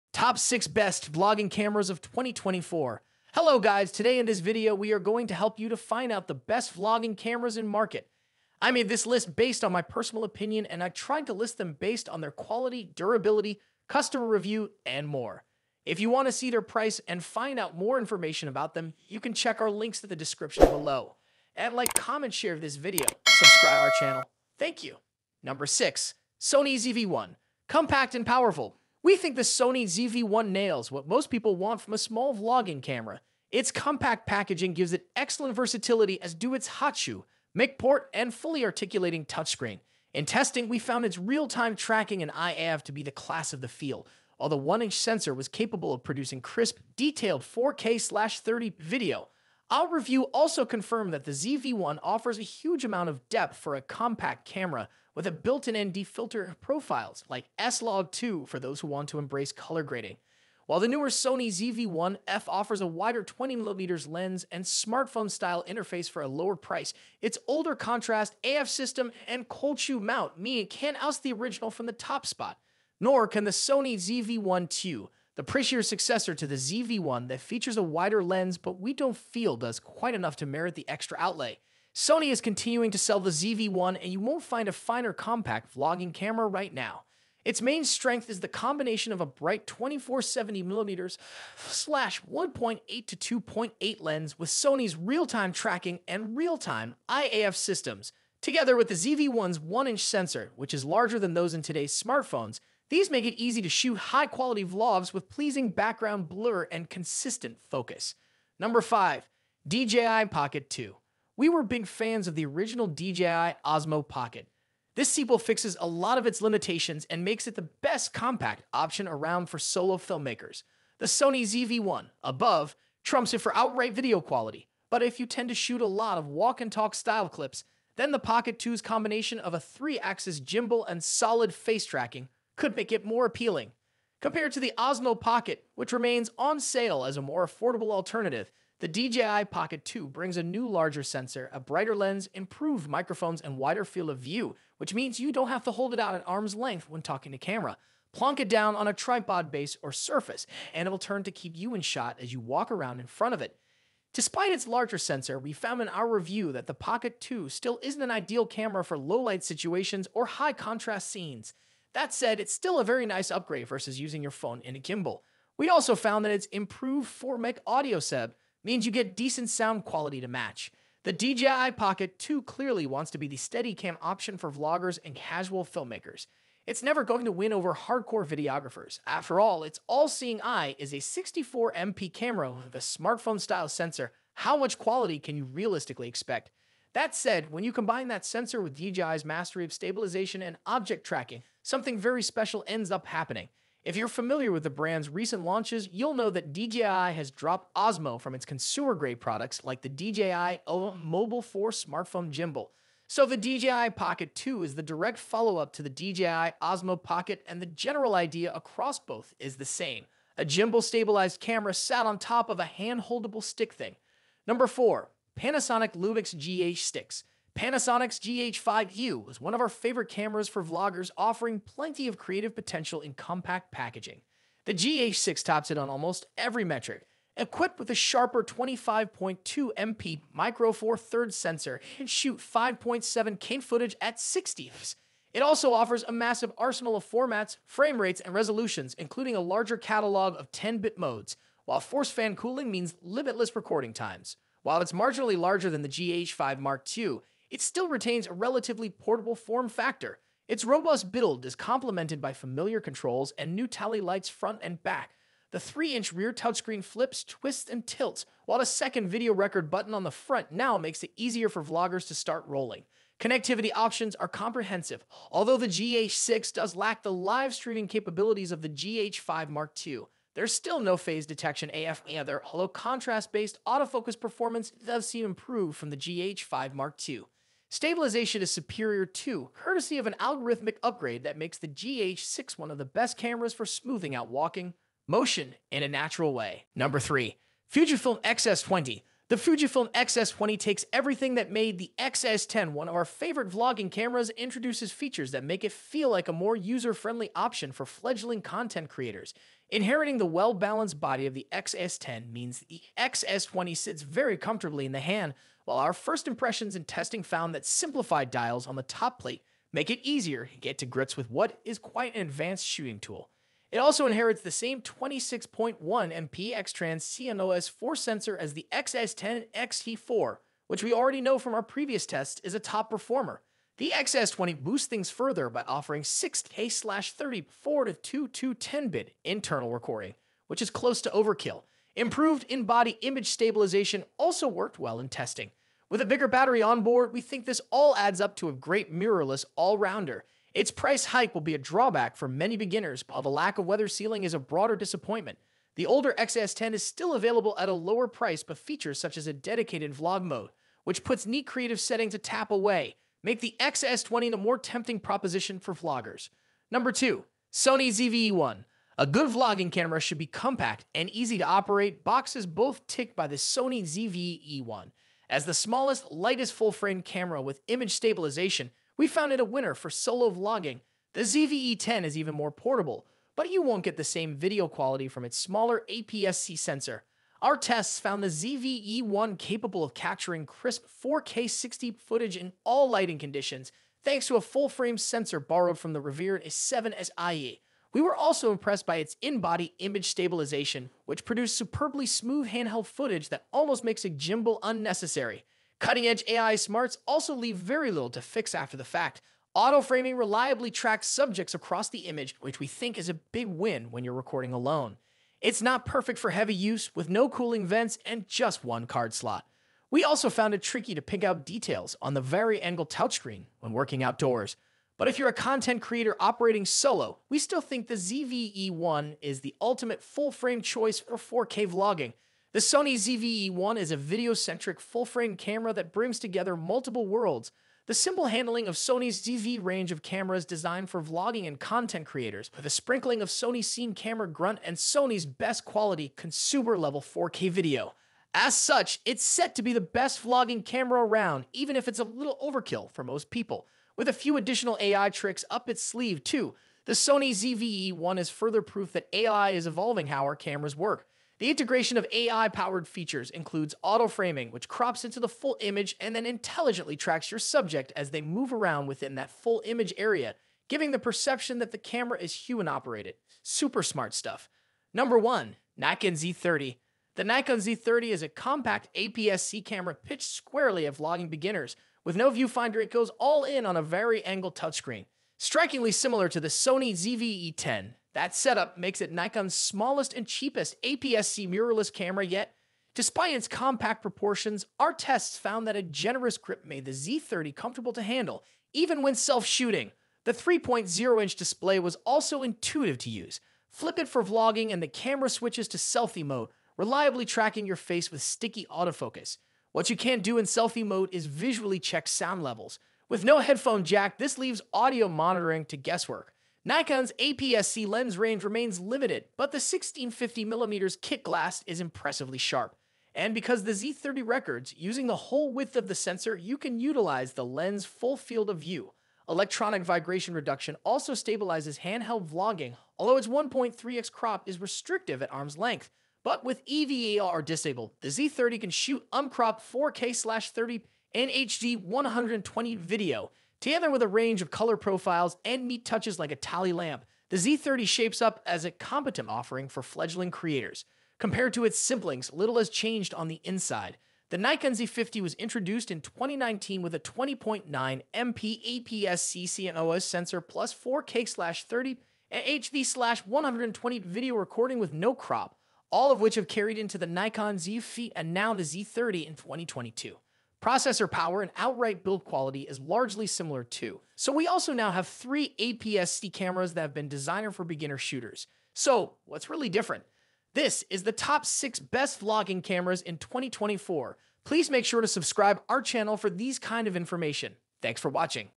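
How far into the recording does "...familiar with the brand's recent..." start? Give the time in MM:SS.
03:14.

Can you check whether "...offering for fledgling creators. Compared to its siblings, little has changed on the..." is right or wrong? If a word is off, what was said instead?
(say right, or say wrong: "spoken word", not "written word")
right.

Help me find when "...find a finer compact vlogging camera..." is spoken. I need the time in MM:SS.
01:24.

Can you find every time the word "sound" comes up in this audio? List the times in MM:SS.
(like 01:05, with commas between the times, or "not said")
02:49, 08:22.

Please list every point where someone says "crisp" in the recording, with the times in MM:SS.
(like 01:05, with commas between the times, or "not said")
00:46, 06:20.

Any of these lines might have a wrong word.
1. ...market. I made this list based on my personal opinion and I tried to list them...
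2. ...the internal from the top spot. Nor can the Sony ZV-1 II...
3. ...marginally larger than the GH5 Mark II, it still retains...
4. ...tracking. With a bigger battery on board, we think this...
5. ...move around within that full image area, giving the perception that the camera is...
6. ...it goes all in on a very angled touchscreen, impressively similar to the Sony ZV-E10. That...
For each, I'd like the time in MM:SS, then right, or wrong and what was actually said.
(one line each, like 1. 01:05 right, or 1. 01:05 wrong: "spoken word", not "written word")
1. 00:07 right
2. 01:11 wrong: "original", not "internal"
3. 04:04 right
4. 05:35 wrong: "testing", not "tracking"
5. 07:38 right
6. 07:52 wrong: "strikingly", not "impressively".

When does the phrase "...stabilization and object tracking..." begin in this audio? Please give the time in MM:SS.
03:09.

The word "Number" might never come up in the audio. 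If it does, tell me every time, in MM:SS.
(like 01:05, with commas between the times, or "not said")
00:25, 01:48, 03:34, 04:46, 05:56, 07:44.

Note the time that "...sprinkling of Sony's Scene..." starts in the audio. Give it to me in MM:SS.
07:12.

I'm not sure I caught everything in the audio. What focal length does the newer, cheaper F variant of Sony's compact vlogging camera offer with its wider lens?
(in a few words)
20mm.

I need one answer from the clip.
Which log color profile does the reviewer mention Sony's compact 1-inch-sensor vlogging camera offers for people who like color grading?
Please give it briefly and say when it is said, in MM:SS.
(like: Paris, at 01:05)
S-Log2, at 00:57.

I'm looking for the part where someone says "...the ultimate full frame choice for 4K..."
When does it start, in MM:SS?
06:59.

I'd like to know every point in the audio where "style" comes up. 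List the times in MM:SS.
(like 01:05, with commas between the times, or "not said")
01:04, 02:06, 03:02.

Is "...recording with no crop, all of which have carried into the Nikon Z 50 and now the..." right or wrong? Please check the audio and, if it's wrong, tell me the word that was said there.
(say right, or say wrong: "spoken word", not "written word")
right.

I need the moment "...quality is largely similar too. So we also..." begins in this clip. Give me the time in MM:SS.
09:22.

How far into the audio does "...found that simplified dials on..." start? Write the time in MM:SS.
05:07.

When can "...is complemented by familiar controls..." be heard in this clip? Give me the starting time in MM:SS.
04:11.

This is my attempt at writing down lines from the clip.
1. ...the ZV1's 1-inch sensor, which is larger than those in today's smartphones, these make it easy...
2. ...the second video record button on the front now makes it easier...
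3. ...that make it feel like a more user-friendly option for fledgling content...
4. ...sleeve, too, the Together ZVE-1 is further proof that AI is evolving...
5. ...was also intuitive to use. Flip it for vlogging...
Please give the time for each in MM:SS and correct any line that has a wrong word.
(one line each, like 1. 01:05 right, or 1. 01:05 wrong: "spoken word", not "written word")
1. 01:38 right
2. 04:18 right
3. 04:55 right
4. 07:25 wrong: "Sony", not "Together"
5. 08:11 right.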